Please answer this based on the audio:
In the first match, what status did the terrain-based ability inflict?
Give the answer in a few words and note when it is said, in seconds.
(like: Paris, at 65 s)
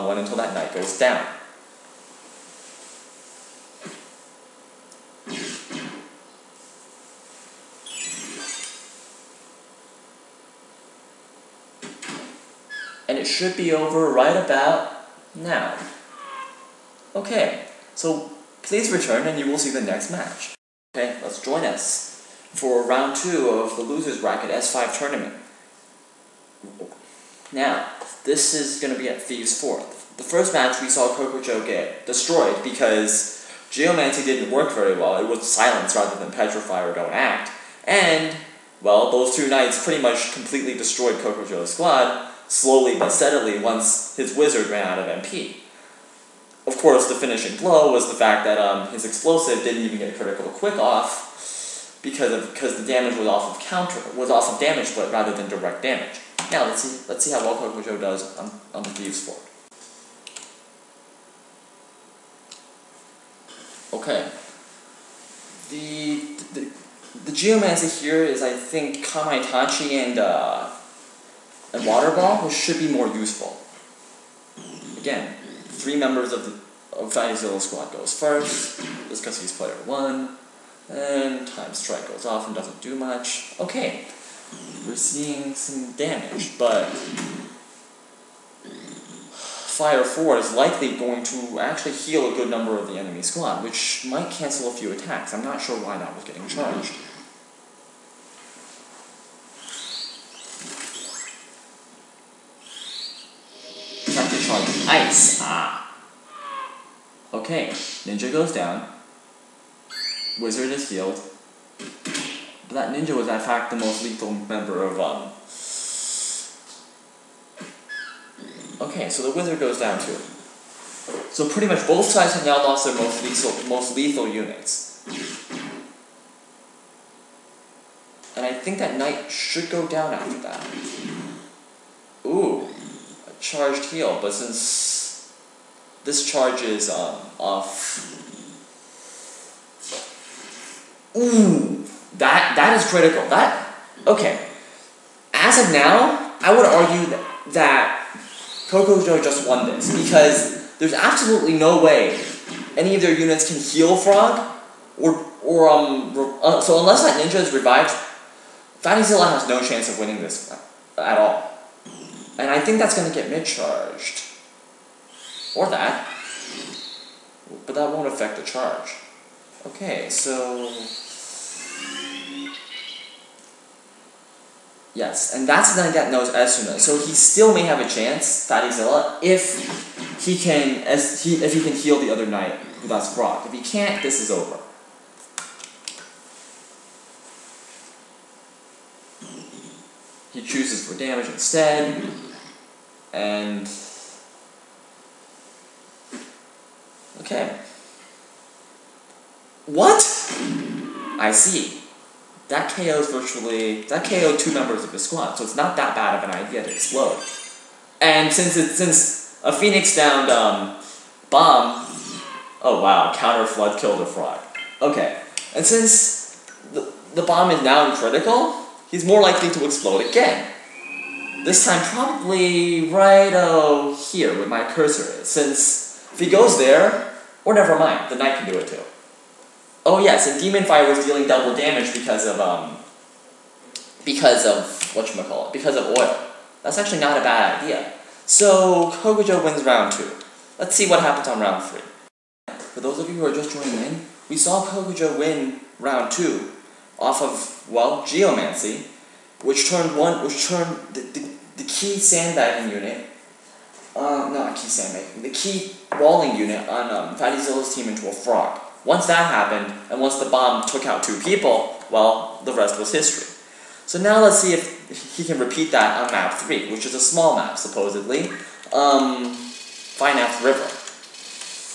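Silence, at 35 s.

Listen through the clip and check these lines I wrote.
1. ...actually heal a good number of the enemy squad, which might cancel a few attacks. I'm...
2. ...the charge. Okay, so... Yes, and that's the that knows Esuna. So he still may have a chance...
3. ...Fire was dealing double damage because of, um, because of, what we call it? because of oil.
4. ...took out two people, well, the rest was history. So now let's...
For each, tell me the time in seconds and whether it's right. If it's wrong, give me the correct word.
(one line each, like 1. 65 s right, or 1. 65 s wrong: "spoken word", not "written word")
1. 91 s right
2. 168 s right
3. 230 s right
4. 260 s right.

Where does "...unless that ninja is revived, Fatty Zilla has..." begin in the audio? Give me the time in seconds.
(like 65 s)
156 s.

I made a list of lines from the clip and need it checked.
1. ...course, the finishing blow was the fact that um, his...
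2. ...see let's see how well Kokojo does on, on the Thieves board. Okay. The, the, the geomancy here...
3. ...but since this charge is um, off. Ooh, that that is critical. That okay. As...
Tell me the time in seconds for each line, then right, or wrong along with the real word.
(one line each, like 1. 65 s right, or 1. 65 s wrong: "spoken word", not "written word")
1. 46 s right
2. 56 s right
3. 134 s right.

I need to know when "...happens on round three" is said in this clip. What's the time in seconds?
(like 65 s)
241 s.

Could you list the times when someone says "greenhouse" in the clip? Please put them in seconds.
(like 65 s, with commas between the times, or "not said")
not said.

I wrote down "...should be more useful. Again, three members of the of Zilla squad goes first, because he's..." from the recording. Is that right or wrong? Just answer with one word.
right.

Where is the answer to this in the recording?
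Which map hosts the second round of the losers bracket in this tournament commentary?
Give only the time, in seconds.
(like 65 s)
29 s.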